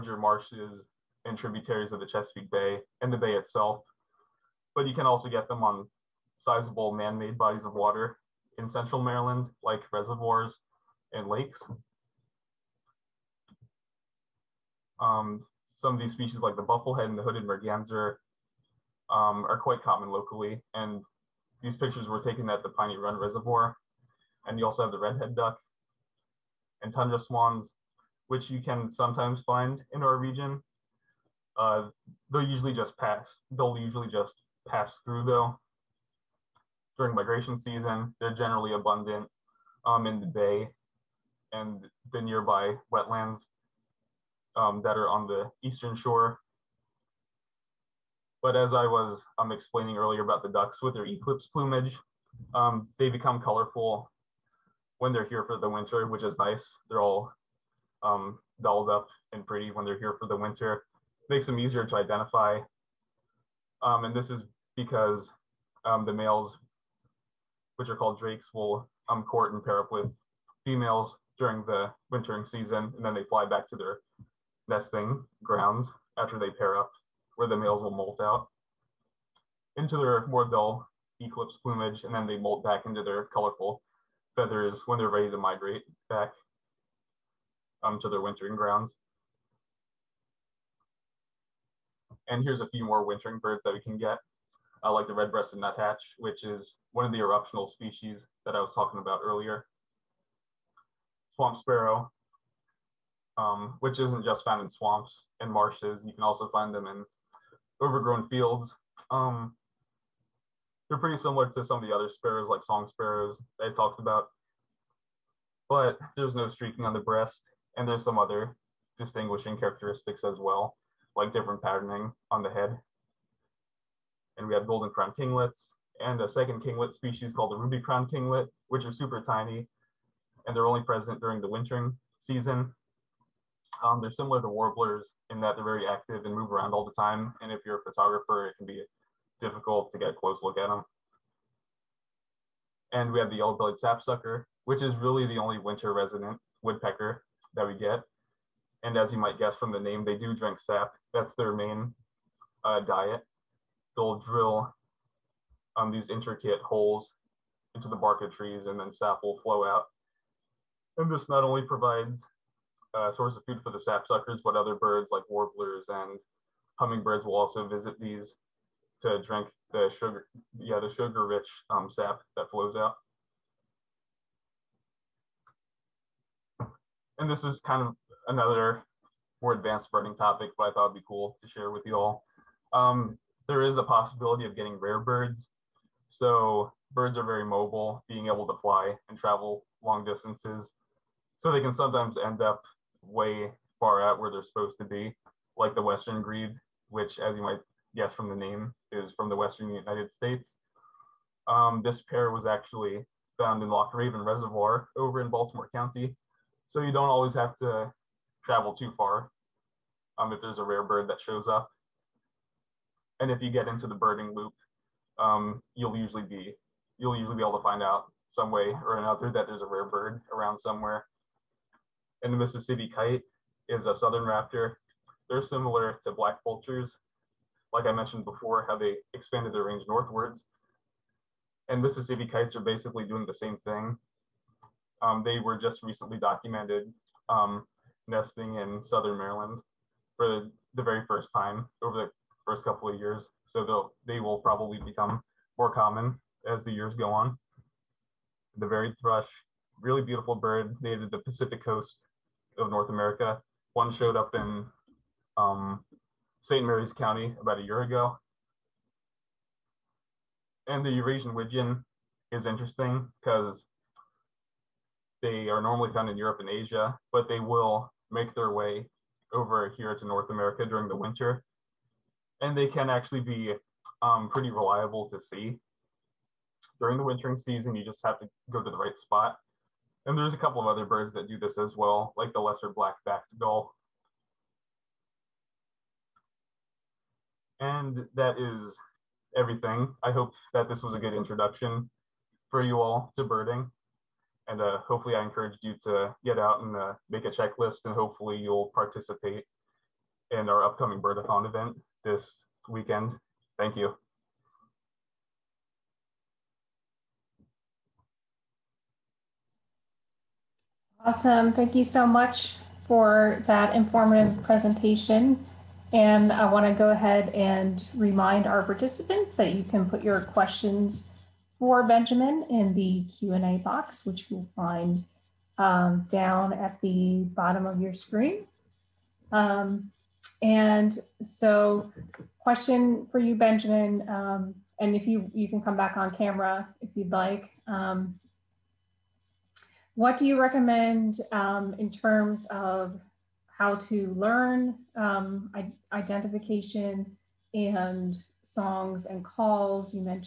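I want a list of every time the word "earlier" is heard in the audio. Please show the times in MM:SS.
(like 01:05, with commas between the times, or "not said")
00:49, 01:39.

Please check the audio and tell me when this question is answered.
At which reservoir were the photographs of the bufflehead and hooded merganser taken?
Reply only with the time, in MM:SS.
00:22.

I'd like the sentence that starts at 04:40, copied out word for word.
And there's a couple of other birds that do this as well, like the lesser black-backed gull.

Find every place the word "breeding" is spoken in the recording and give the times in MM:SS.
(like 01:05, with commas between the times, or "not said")
02:59.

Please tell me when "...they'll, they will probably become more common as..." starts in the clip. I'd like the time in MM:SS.
04:03.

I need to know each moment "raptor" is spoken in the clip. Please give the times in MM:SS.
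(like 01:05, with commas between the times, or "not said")
03:44.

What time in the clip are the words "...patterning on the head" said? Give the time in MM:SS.
02:01.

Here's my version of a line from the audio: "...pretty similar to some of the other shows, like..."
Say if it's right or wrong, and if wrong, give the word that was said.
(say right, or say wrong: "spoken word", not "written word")
wrong: "sparrows", not "shows".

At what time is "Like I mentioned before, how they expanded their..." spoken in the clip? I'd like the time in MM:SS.
03:47.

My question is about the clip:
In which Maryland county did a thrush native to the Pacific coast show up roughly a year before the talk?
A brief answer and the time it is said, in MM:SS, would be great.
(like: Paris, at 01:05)
St. Mary's County, at 04:16.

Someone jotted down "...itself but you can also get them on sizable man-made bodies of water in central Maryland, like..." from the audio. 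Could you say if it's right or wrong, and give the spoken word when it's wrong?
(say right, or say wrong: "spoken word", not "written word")
right.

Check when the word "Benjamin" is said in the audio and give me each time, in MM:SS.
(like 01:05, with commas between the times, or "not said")
05:21, 05:33.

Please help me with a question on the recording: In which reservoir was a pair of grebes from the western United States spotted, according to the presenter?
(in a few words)
Loch Raven Reservoir.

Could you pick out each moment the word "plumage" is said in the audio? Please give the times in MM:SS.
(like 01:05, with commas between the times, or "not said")
00:51, 01:21.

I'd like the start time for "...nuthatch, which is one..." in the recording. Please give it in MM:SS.
01:35.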